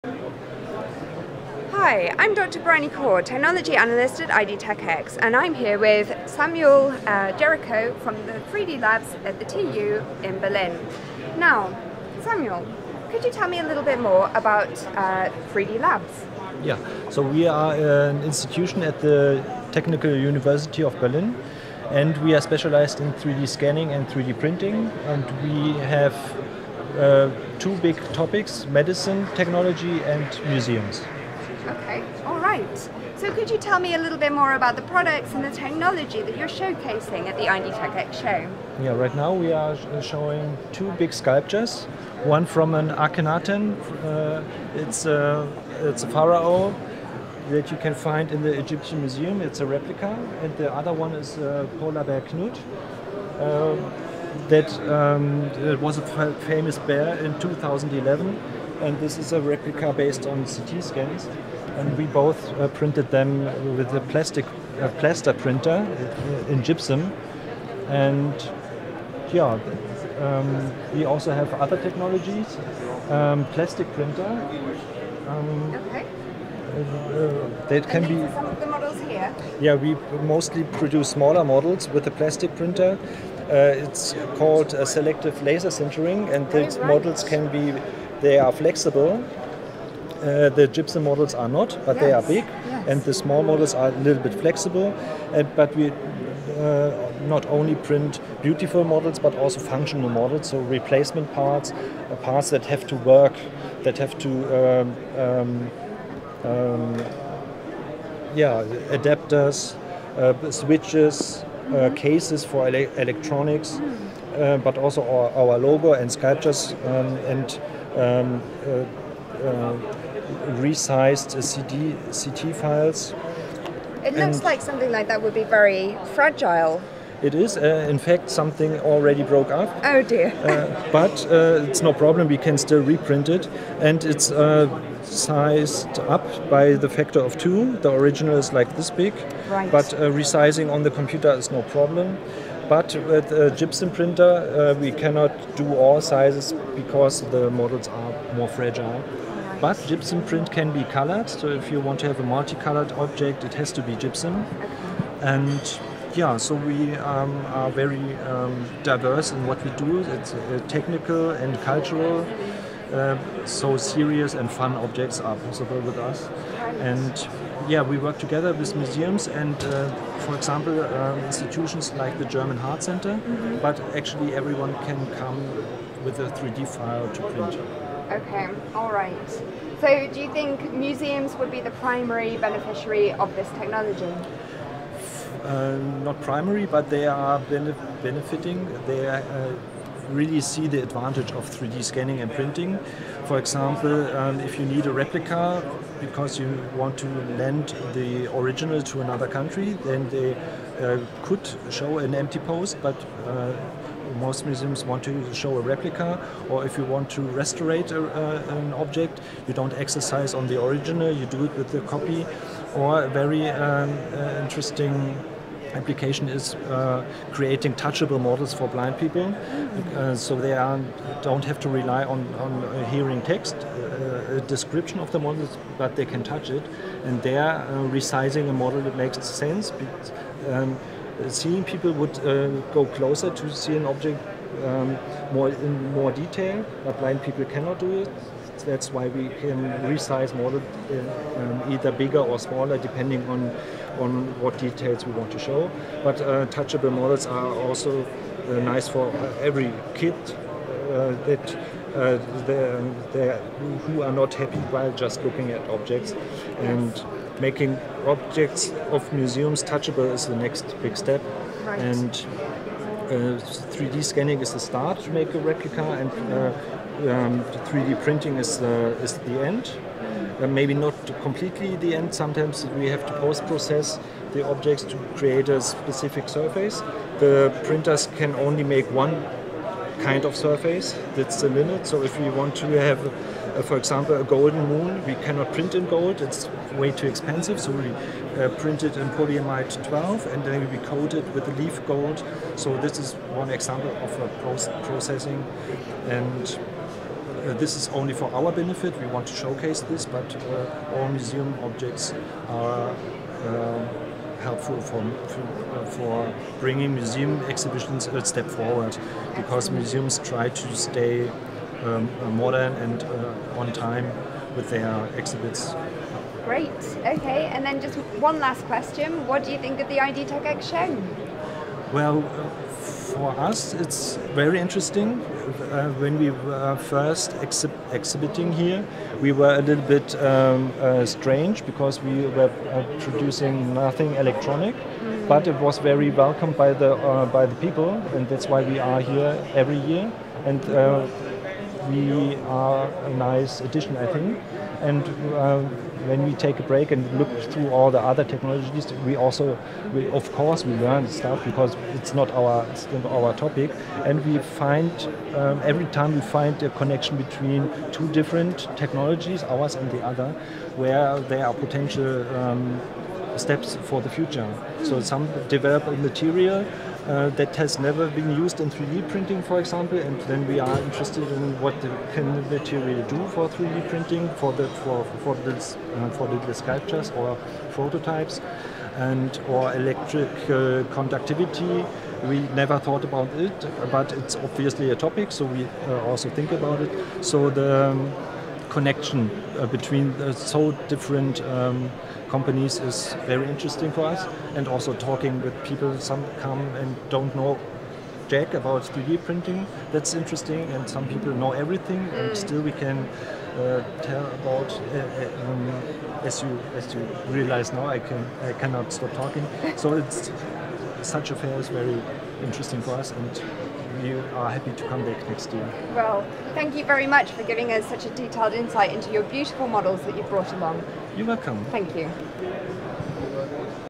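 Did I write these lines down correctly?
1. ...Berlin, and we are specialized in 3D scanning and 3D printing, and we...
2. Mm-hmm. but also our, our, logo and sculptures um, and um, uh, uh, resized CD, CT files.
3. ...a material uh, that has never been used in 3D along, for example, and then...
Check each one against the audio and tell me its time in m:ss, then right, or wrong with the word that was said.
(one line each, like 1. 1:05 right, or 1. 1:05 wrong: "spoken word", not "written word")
1. 0:21 right
2. 1:53 right
3. 6:05 wrong: "printing", not "along".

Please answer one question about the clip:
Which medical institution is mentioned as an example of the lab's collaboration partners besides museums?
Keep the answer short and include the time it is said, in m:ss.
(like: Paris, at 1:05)
German Heart Center, at 2:52.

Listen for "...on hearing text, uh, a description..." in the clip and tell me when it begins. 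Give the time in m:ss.
3:42.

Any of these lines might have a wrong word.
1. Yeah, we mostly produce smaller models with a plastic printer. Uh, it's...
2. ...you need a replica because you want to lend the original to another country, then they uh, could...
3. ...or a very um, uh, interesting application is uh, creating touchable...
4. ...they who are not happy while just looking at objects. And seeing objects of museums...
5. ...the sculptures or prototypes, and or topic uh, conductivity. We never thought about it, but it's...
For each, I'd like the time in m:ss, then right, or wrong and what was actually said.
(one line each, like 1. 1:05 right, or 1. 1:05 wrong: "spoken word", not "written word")
1. 1:19 right
2. 3:14 right
3. 3:32 right
4. 4:13 wrong: "making", not "seeing"
5. 6:16 wrong: "electric", not "topic".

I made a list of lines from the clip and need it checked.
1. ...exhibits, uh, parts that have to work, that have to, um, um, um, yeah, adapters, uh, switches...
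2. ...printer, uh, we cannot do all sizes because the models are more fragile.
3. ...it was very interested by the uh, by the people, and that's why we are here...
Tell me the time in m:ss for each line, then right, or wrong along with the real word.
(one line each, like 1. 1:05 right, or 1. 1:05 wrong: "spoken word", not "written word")
1. 1:41 wrong: "parts", not "exhibits"
2. 2:23 right
3. 5:35 wrong: "welcomed", not "interested".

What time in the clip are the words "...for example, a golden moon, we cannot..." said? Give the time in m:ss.
4:43.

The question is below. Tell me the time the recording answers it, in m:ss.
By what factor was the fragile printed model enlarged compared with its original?
2:16.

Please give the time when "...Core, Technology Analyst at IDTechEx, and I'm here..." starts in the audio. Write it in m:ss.
0:02.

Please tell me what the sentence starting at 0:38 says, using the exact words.
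Yeah, right now we are showing two big sculptures.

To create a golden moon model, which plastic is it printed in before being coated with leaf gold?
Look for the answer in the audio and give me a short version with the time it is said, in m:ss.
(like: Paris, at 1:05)
Polyamide 12, at 4:49.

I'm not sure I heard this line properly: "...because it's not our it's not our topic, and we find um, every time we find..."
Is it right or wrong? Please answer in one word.
right.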